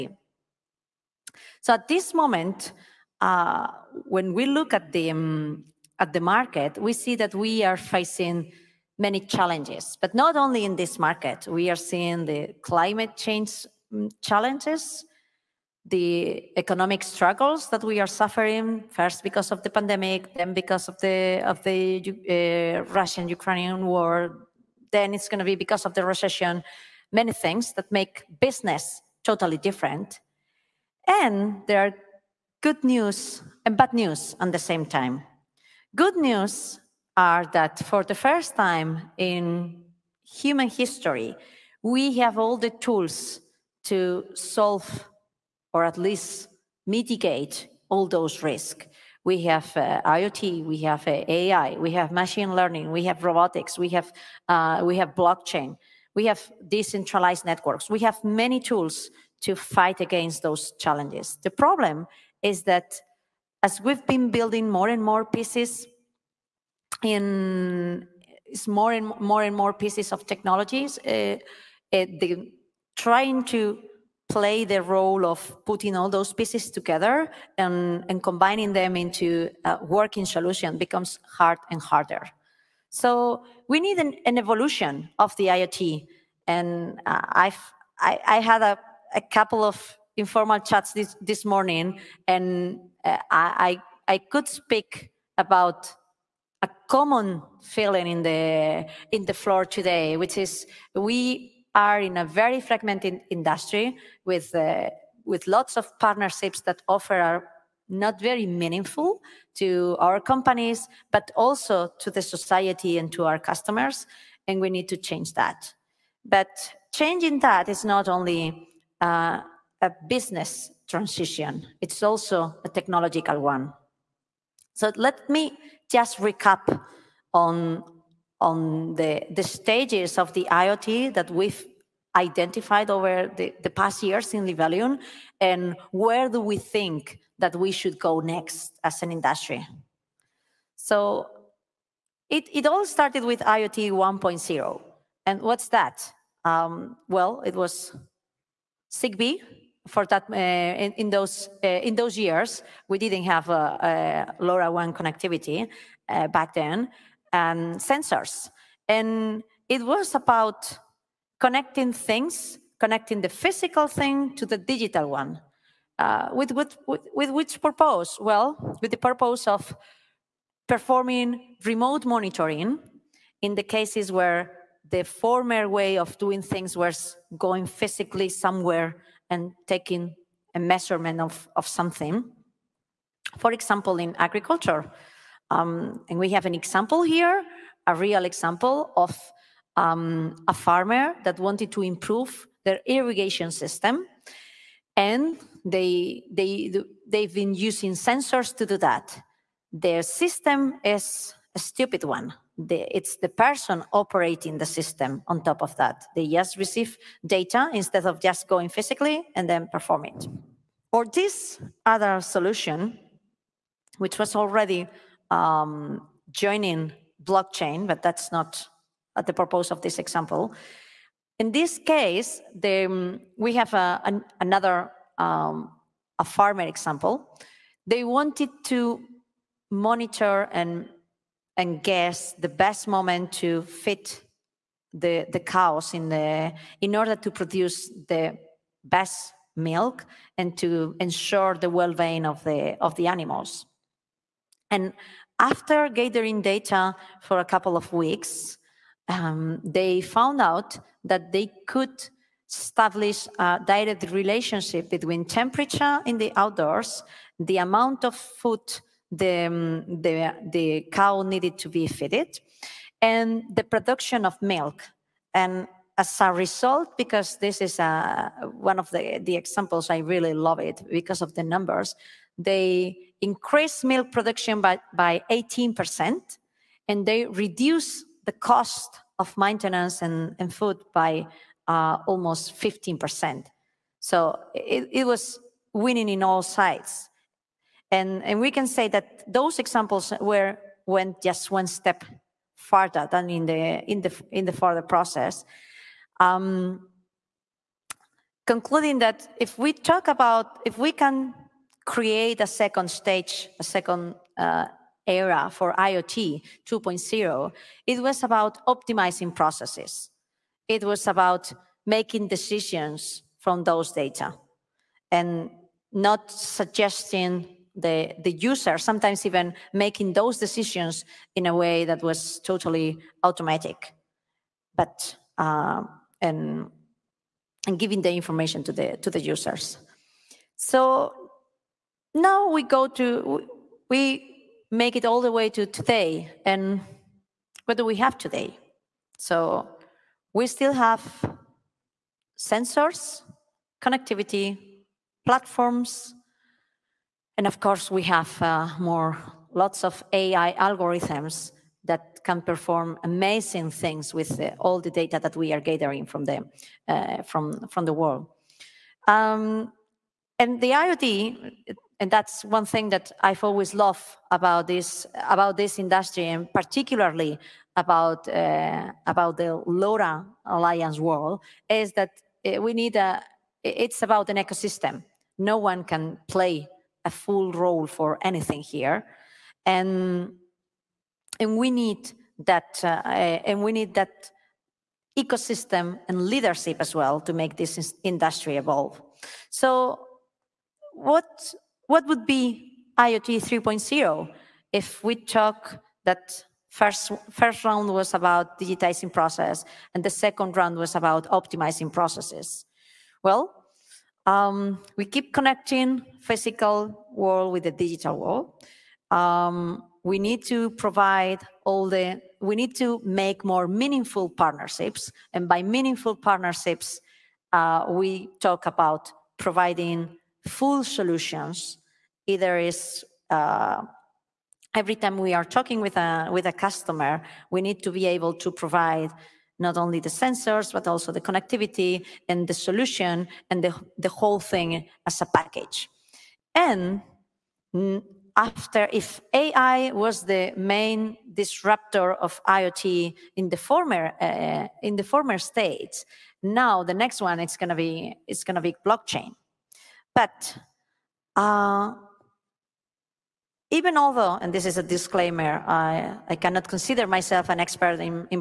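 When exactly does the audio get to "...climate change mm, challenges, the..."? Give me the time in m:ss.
0:12.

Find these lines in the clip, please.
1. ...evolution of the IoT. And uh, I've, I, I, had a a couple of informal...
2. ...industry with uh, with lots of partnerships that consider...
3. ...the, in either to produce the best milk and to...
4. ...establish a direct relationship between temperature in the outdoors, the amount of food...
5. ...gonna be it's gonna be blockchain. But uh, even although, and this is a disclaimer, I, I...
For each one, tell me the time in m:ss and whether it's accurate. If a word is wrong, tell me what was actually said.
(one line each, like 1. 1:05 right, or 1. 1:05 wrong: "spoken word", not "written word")
1. 1:24 right
2. 1:43 wrong: "offer", not "consider"
3. 3:56 wrong: "order", not "either"
4. 4:12 right
5. 7:27 right.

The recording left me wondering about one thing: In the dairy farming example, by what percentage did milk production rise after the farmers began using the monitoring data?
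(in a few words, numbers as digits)
18%.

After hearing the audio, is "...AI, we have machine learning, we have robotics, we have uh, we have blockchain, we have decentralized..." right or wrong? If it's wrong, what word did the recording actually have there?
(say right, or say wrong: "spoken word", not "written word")
right.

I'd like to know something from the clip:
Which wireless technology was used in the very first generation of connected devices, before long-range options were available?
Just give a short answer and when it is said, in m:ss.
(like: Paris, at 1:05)
ZigBee, at 2:28.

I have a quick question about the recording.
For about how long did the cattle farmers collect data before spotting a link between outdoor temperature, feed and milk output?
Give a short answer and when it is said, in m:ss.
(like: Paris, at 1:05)
a couple of weeks, at 4:07.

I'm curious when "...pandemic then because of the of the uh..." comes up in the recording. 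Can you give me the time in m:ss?
0:19.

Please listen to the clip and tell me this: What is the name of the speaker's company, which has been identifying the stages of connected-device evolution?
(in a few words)
Libelium.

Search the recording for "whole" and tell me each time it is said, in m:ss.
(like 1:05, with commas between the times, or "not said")
7:14.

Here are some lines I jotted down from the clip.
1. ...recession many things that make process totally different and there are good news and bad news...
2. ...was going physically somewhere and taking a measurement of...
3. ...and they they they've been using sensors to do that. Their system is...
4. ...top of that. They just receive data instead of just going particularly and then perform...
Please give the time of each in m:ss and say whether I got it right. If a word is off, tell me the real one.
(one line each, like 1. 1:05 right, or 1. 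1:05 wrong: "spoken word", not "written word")
1. 0:26 wrong: "business", not "process"
2. 2:56 right
3. 3:14 right
4. 3:25 wrong: "physically", not "particularly".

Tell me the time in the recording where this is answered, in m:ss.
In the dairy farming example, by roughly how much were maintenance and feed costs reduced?
4:42.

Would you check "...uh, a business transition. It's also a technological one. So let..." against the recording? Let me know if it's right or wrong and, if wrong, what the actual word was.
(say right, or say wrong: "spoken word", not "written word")
right.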